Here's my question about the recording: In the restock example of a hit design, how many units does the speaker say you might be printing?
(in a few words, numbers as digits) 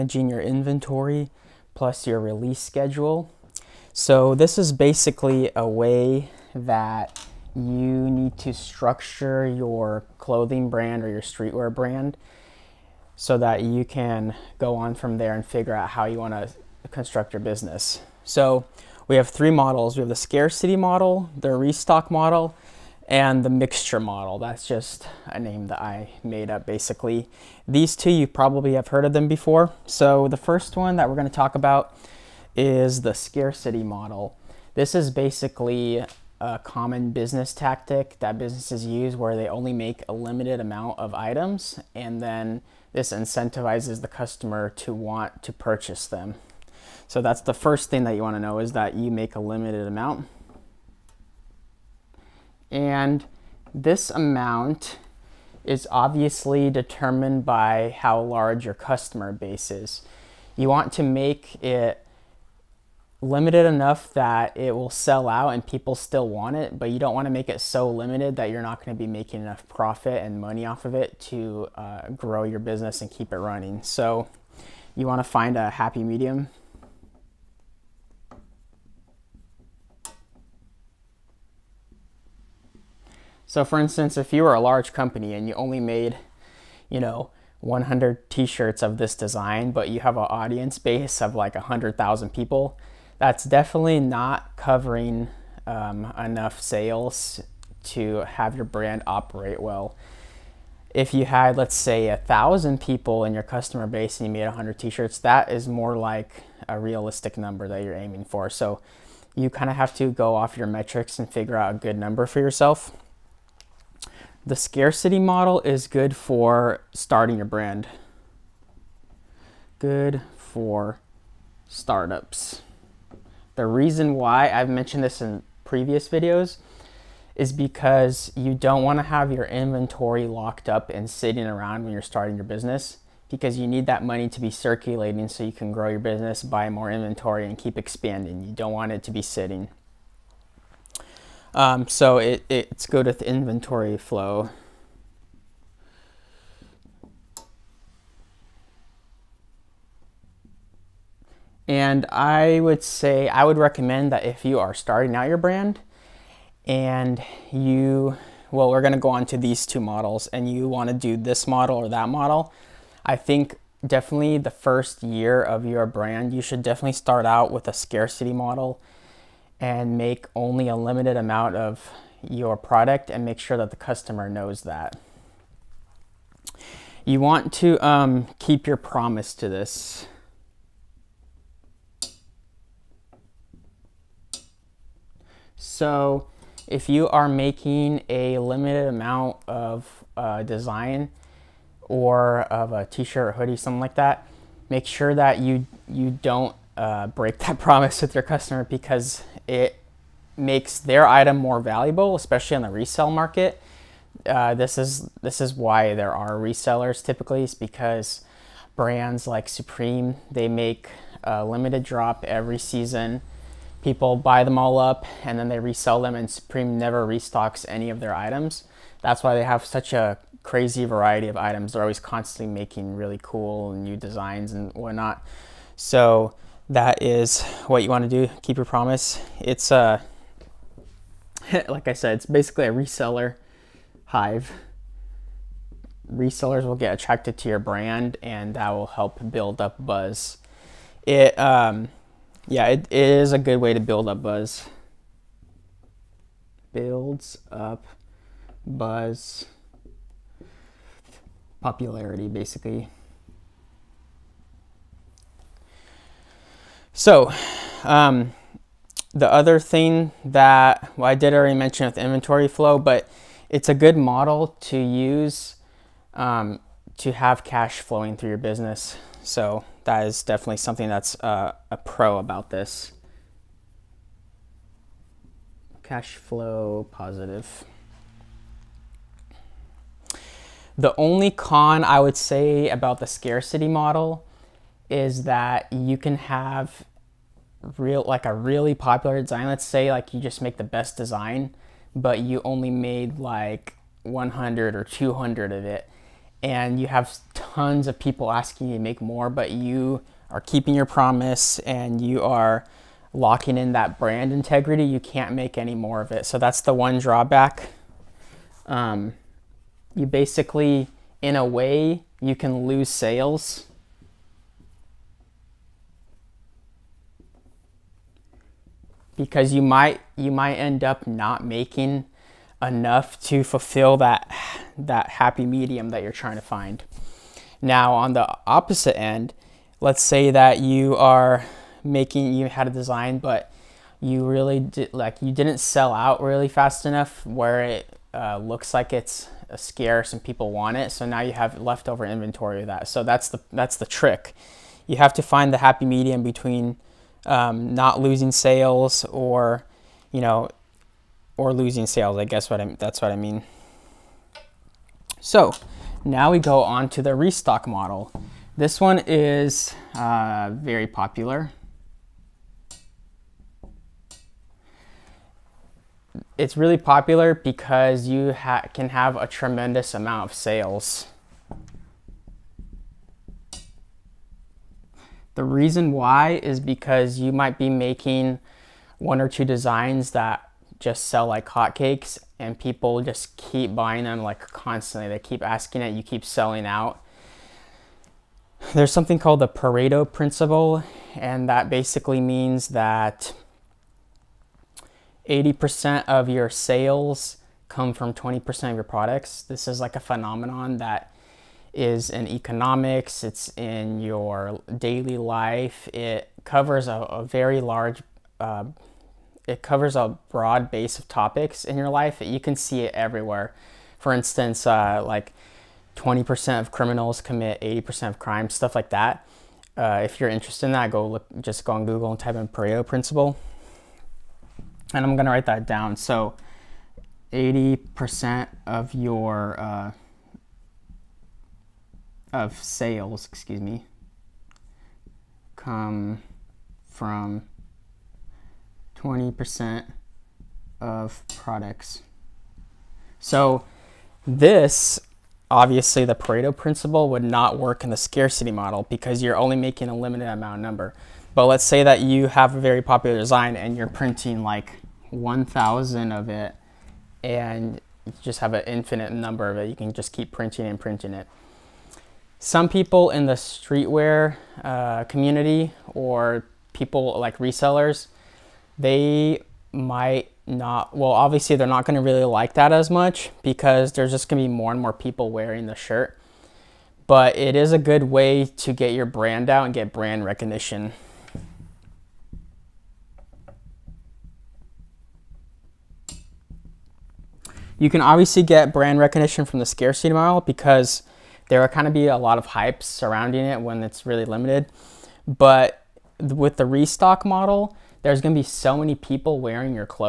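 1,000.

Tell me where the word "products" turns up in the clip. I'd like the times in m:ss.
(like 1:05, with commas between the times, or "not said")
2:52, 6:38, 7:21.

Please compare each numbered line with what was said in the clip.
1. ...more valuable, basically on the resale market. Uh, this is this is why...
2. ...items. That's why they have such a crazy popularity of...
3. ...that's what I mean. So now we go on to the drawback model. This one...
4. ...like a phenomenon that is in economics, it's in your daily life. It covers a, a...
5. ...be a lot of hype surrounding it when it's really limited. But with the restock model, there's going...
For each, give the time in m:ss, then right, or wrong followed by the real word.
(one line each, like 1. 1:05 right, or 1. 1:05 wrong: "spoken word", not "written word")
1. 3:21 wrong: "especially", not "basically"
2. 3:38 wrong: "variety", not "popularity"
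3. 5:52 wrong: "restock", not "drawback"
4. 6:39 right
5. 8:11 right.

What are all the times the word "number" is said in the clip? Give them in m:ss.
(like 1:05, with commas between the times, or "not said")
1:47, 1:51, 7:30, 7:39.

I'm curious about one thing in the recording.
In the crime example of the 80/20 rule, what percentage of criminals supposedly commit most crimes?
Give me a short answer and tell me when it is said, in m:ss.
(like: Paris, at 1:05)
20%, at 6:55.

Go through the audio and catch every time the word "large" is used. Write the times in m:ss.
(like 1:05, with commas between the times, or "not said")
0:58, 1:24, 6:47.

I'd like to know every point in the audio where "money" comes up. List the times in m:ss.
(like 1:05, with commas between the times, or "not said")
1:10, 2:14.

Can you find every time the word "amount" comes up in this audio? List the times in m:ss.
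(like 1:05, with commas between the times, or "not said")
0:40, 0:49, 0:54, 2:51, 3:08, 6:09, 7:30.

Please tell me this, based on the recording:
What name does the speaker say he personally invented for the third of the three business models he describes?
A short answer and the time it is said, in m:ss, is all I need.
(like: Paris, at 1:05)
mixture model, at 0:23.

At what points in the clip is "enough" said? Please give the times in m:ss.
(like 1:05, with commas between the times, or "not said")
1:03, 1:09, 1:36, 5:22, 5:36.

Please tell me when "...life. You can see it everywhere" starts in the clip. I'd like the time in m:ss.
6:51.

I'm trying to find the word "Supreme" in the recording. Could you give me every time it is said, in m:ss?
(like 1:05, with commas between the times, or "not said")
3:29, 3:36.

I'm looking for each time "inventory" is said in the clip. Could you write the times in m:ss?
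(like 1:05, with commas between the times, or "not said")
0:00, 2:09, 2:16, 2:23, 4:21, 5:42.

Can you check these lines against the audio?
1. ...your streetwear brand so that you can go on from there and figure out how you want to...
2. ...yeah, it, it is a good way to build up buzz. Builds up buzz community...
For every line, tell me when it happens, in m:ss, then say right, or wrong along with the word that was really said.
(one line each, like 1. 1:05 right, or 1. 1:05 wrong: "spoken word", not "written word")
1. 0:11 right
2. 4:02 wrong: "popularity", not "community".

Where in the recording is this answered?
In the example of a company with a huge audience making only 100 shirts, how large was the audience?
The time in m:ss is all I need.
1:31.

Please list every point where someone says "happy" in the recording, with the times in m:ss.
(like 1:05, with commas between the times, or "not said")
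1:15, 5:25, 5:45.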